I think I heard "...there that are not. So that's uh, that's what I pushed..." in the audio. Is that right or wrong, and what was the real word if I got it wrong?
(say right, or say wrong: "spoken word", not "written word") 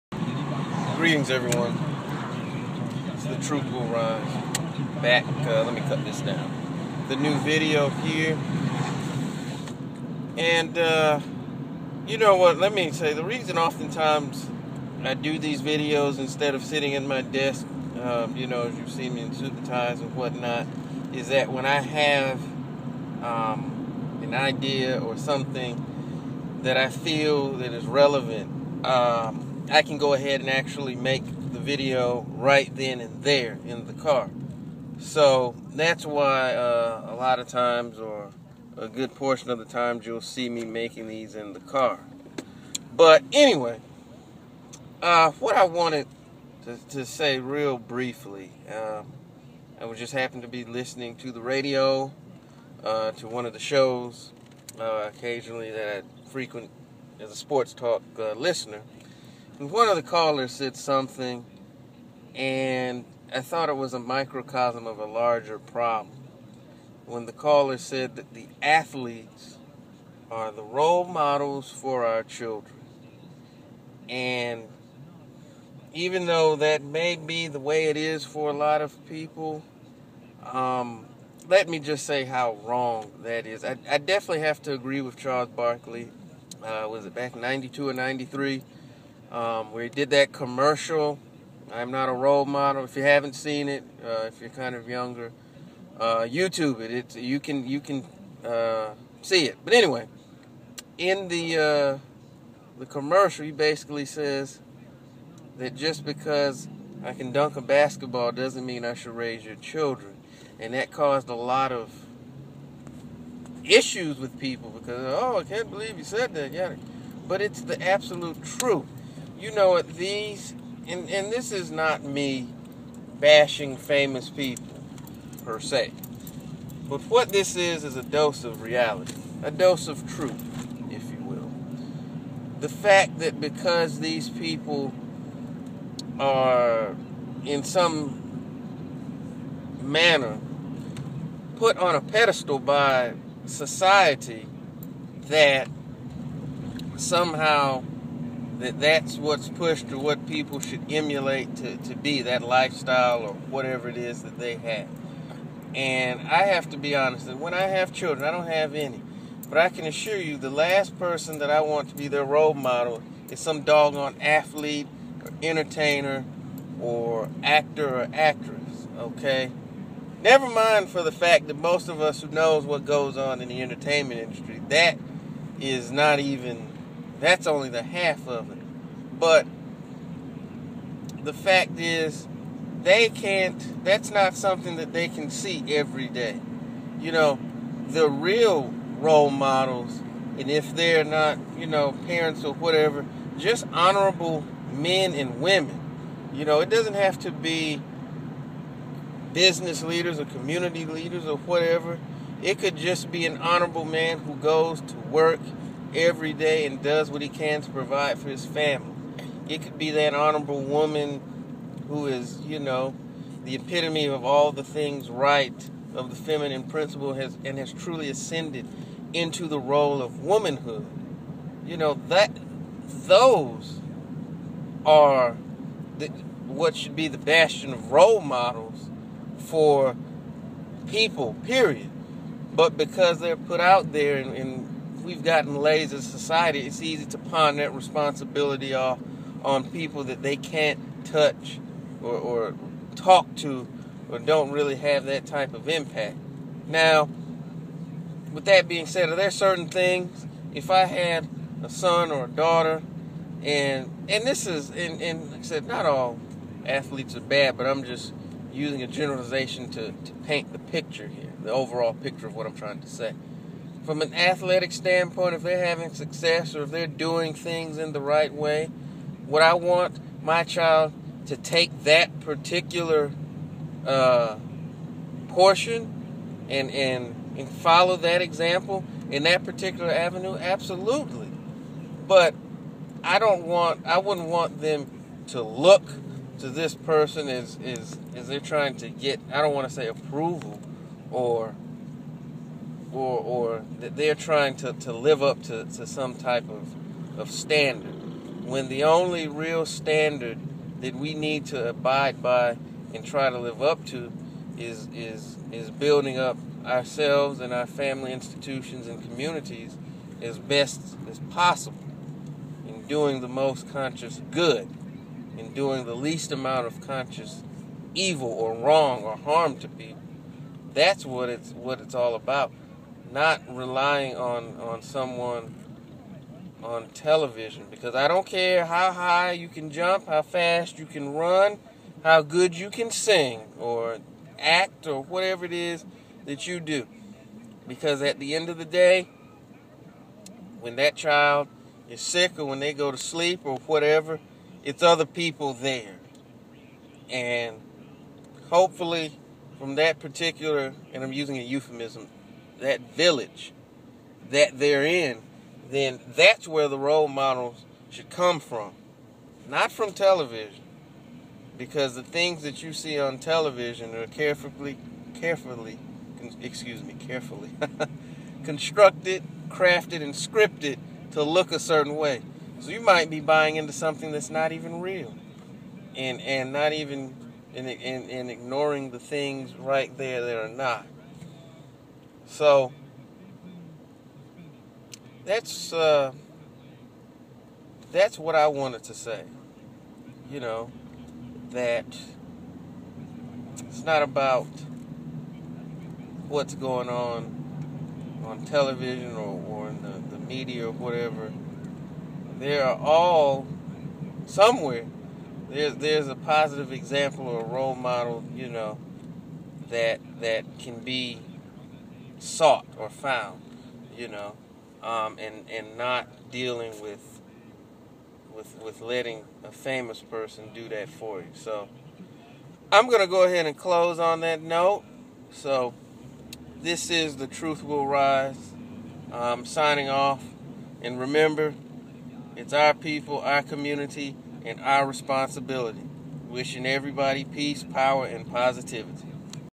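wrong: "wanted", not "pushed".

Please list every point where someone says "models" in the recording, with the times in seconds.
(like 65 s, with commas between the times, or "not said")
71 s, 92 s, 162 s, 189 s, 228 s, 357 s, 407 s.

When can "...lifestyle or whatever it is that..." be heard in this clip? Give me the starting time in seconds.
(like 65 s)
152 s.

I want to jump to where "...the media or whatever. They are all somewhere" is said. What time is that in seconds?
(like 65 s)
400 s.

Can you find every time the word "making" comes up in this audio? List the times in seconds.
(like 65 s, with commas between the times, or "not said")
40 s.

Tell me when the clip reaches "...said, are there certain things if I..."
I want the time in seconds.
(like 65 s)
248 s.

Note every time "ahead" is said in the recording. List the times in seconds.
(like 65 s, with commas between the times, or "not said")
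30 s, 423 s.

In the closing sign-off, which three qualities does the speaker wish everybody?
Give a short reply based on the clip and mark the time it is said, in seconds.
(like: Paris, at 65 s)
Peace, power, and positivity, at 437 s.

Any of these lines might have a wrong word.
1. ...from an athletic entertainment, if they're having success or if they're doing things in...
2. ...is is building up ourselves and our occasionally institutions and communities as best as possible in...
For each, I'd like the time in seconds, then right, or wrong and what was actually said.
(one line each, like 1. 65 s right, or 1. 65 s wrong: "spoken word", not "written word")
1. 263 s wrong: "standpoint", not "entertainment"
2. 304 s wrong: "family", not "occasionally".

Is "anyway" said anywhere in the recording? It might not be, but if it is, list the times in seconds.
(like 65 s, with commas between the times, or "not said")
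43 s, 99 s.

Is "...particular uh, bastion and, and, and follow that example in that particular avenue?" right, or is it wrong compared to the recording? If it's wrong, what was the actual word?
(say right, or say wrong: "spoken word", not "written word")
wrong: "portion", not "bastion".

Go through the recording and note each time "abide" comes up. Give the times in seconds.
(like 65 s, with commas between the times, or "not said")
301 s.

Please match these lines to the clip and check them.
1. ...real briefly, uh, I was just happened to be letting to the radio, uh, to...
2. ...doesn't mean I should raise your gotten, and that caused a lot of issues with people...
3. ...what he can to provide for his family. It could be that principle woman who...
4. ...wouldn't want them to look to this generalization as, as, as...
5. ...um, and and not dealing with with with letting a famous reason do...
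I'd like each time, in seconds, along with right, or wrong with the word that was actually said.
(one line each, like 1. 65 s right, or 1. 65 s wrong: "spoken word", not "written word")
1. 47 s wrong: "listening", not "letting"
2. 108 s wrong: "children", not "gotten"
3. 207 s wrong: "honorable", not "principle"
4. 283 s wrong: "person", not "generalization"
5. 414 s wrong: "person", not "reason".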